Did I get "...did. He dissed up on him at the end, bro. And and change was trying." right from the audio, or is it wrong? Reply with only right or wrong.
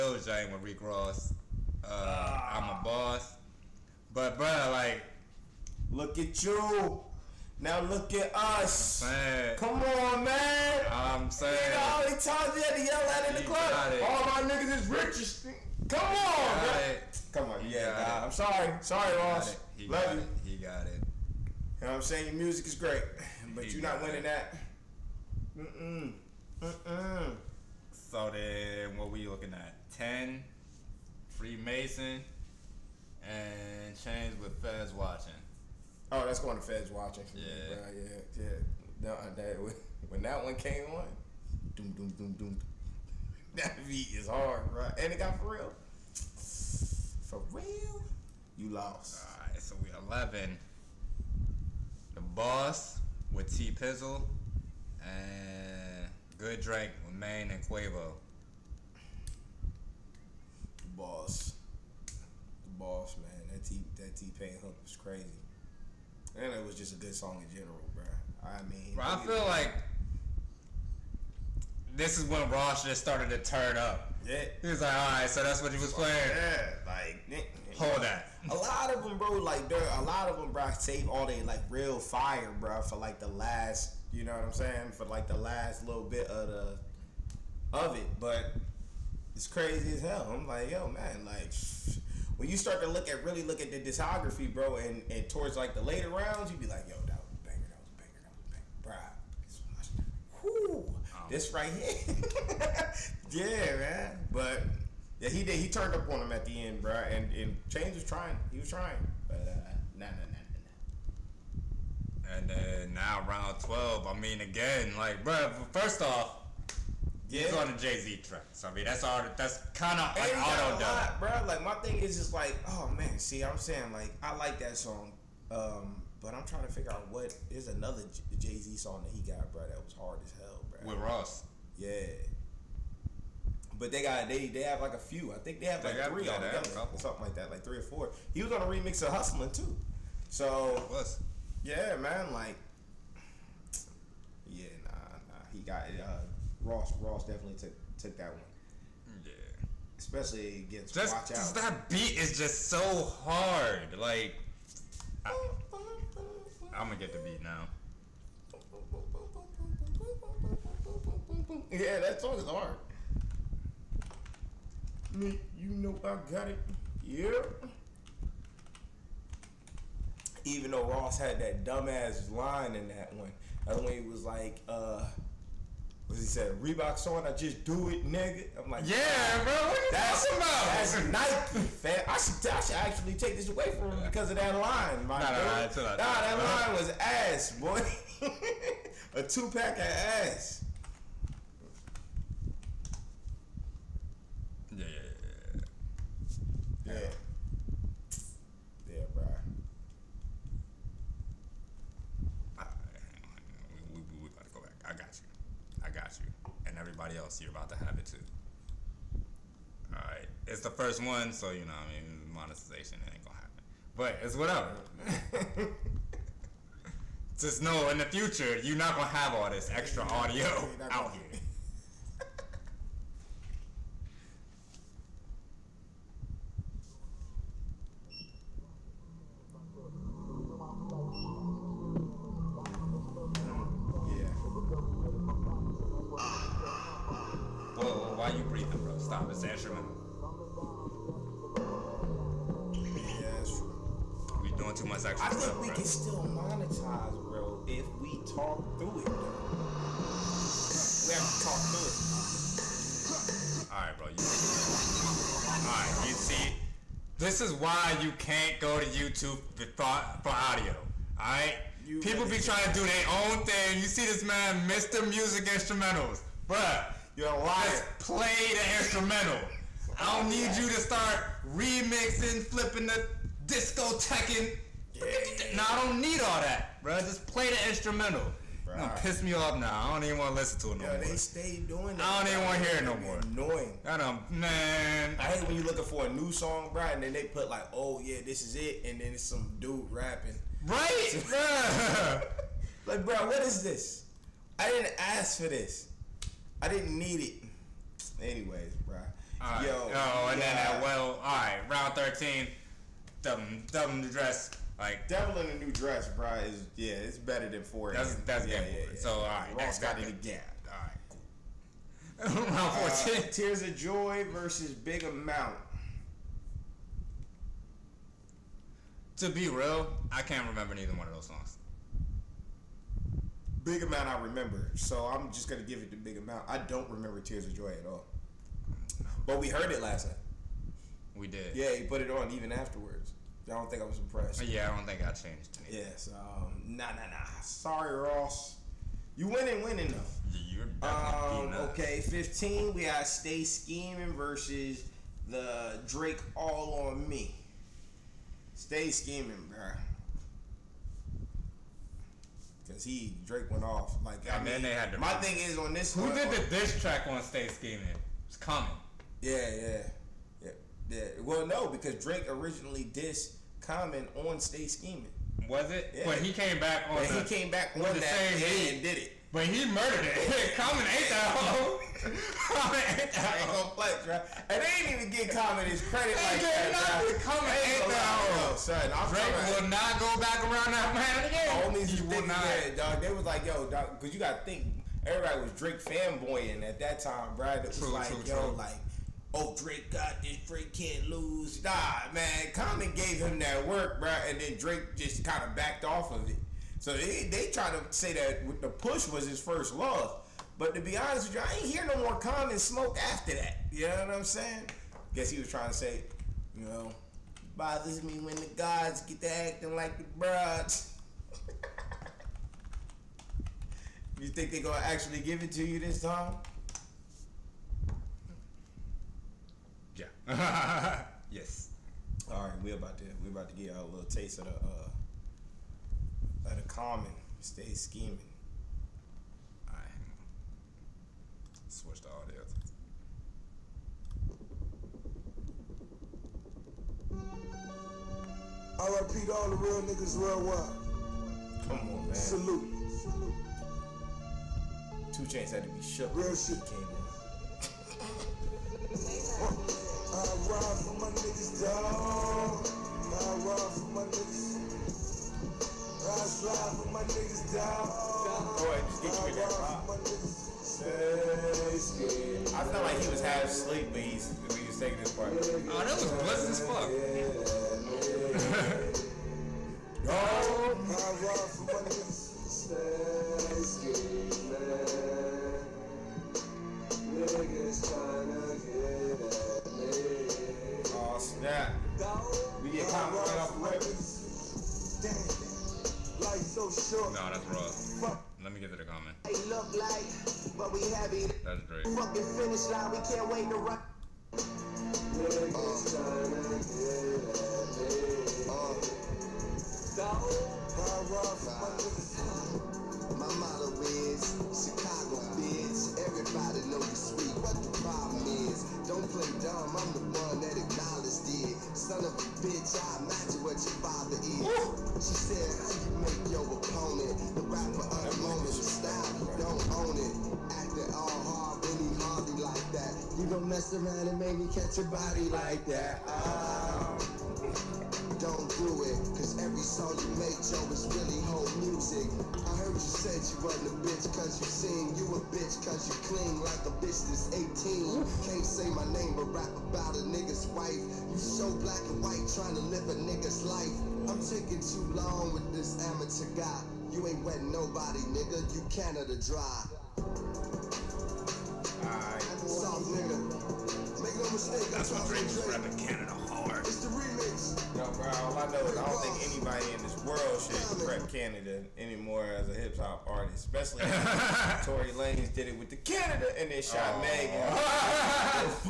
wrong.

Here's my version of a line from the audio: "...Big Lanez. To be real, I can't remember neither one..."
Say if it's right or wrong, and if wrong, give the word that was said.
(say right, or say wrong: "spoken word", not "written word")
wrong: "Amount", not "Lanez".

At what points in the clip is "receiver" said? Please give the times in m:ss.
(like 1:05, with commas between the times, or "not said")
not said.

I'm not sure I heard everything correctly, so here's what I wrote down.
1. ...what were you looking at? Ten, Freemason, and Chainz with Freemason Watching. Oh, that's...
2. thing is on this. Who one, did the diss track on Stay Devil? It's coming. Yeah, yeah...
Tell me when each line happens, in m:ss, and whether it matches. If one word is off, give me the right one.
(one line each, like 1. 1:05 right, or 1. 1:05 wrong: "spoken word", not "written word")
1. 0:28 wrong: "Feds", not "Freemason"
2. 5:55 wrong: "Scheming", not "Devil".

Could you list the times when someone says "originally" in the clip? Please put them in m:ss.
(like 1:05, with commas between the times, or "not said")
6:02.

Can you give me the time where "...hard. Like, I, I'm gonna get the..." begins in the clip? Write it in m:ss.
2:33.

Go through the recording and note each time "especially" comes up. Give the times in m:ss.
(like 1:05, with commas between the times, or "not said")
2:29, 9:23.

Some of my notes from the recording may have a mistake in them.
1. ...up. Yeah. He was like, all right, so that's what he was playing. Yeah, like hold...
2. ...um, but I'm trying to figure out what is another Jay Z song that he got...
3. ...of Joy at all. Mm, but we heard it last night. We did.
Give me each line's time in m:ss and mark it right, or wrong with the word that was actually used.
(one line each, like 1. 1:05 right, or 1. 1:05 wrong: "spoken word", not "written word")
1. 1:13 right
2. 2:05 right
3. 5:27 right.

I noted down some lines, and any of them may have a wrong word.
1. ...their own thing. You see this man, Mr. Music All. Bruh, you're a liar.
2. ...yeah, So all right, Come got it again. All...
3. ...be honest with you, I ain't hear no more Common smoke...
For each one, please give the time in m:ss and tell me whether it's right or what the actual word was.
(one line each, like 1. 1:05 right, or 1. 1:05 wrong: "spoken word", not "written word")
1. 4:22 wrong: "Instrumentals", not "All"
2. 5:08 wrong: "Ross", not "Come"
3. 6:40 right.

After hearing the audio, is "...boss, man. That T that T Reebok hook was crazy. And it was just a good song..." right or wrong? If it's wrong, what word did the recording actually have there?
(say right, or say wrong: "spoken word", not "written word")
wrong: "Pain", not "Reebok".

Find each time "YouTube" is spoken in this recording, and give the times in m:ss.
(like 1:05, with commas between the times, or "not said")
4:18.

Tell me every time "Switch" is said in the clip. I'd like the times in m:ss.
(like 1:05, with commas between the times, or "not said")
7:11.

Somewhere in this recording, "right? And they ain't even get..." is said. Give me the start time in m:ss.
6:13.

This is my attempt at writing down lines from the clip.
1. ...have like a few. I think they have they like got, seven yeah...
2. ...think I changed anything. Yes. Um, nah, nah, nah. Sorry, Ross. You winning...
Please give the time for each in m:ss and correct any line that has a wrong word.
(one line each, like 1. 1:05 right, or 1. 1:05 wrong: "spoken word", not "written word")
1. 2:14 wrong: "three", not "seven"
2. 5:34 right.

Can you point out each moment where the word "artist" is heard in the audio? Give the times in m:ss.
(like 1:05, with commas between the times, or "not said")
9:23.